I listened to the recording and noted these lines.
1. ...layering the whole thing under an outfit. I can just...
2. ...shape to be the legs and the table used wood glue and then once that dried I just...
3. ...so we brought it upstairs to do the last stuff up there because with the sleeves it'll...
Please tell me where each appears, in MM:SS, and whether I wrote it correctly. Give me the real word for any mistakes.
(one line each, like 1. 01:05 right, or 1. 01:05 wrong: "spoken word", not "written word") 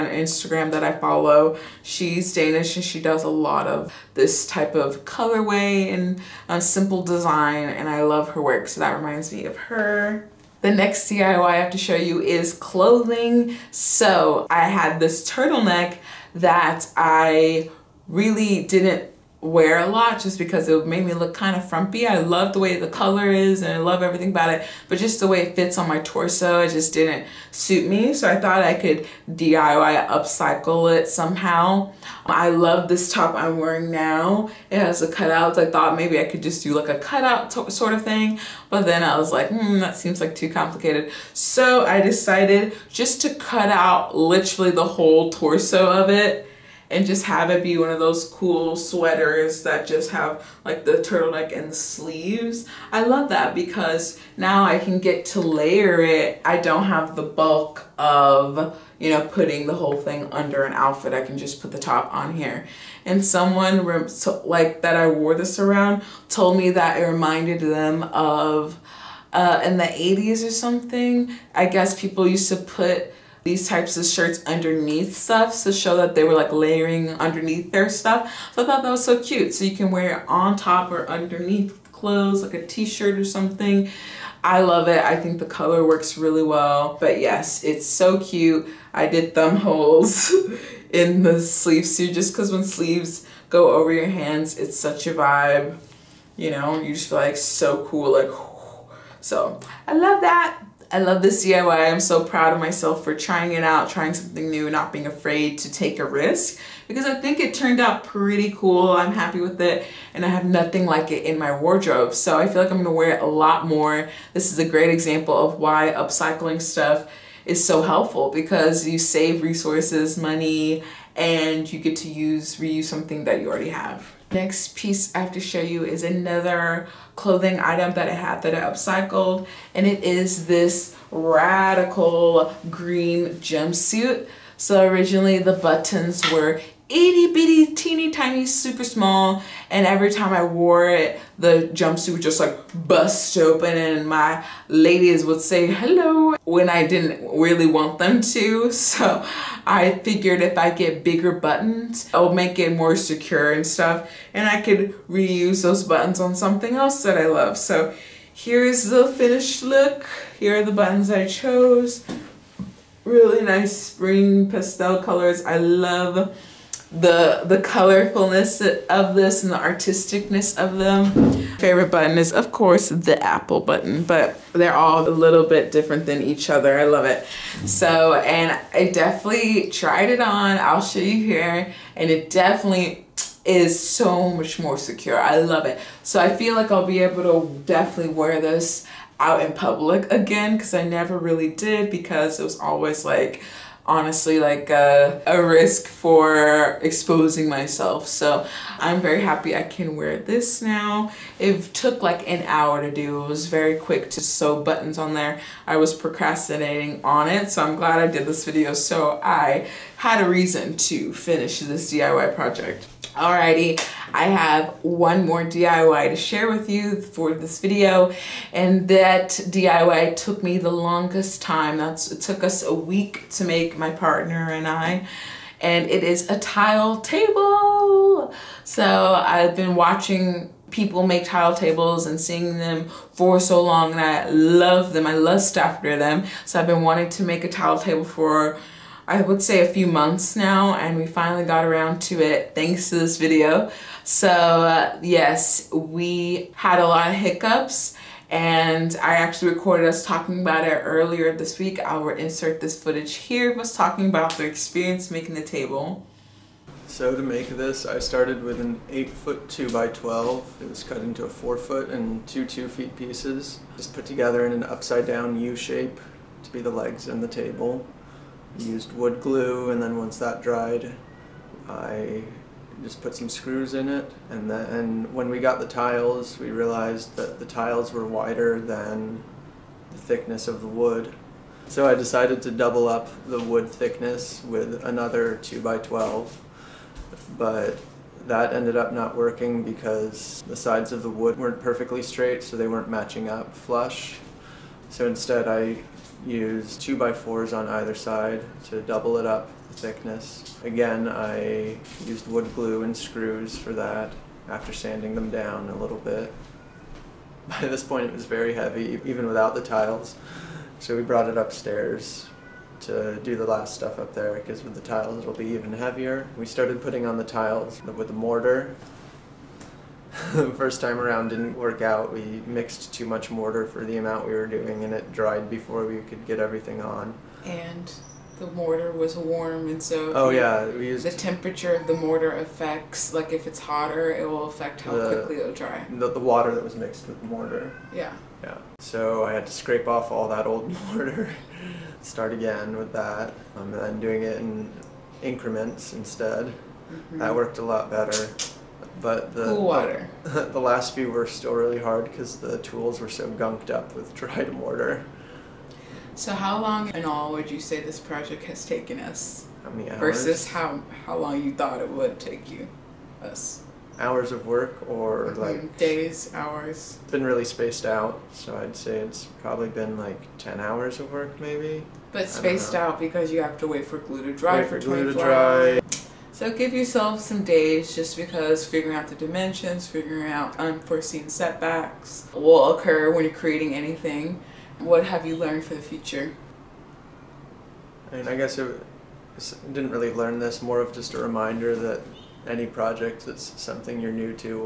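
1. 00:59 wrong: "putting", not "layering"
2. 04:25 right
3. 05:10 wrong: "tiles", not "sleeves".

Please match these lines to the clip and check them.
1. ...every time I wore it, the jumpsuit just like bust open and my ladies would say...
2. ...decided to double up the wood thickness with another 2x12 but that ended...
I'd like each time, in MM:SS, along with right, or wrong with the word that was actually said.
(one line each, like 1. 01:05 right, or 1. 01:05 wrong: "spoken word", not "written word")
1. 02:19 right
2. 04:41 right.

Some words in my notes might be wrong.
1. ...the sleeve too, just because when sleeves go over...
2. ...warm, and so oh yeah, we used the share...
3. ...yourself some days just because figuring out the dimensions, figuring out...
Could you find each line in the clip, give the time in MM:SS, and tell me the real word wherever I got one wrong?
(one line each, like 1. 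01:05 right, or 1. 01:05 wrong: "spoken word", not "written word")
1. 01:31 right
2. 05:29 wrong: "temperature", not "share"
3. 06:16 right.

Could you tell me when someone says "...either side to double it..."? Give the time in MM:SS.
04:57.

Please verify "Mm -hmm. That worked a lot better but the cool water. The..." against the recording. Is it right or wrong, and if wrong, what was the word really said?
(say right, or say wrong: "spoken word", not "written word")
right.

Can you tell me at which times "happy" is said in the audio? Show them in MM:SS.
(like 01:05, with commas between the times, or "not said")
01:49, 03:19.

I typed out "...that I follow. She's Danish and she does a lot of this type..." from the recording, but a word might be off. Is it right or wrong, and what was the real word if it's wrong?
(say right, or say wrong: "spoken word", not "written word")
right.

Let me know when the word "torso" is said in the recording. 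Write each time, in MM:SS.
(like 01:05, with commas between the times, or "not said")
00:25, 00:45.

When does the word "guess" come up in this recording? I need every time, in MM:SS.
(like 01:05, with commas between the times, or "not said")
01:11, 06:28.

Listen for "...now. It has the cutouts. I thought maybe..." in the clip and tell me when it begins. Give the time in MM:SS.
00:33.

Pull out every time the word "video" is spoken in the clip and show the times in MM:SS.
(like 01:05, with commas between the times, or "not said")
03:28, 03:37, 04:03.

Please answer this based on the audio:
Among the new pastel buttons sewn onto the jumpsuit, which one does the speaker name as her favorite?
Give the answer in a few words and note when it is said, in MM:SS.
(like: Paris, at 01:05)
apple button, at 02:53.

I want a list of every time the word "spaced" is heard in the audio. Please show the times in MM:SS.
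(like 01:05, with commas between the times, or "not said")
06:07, 06:12.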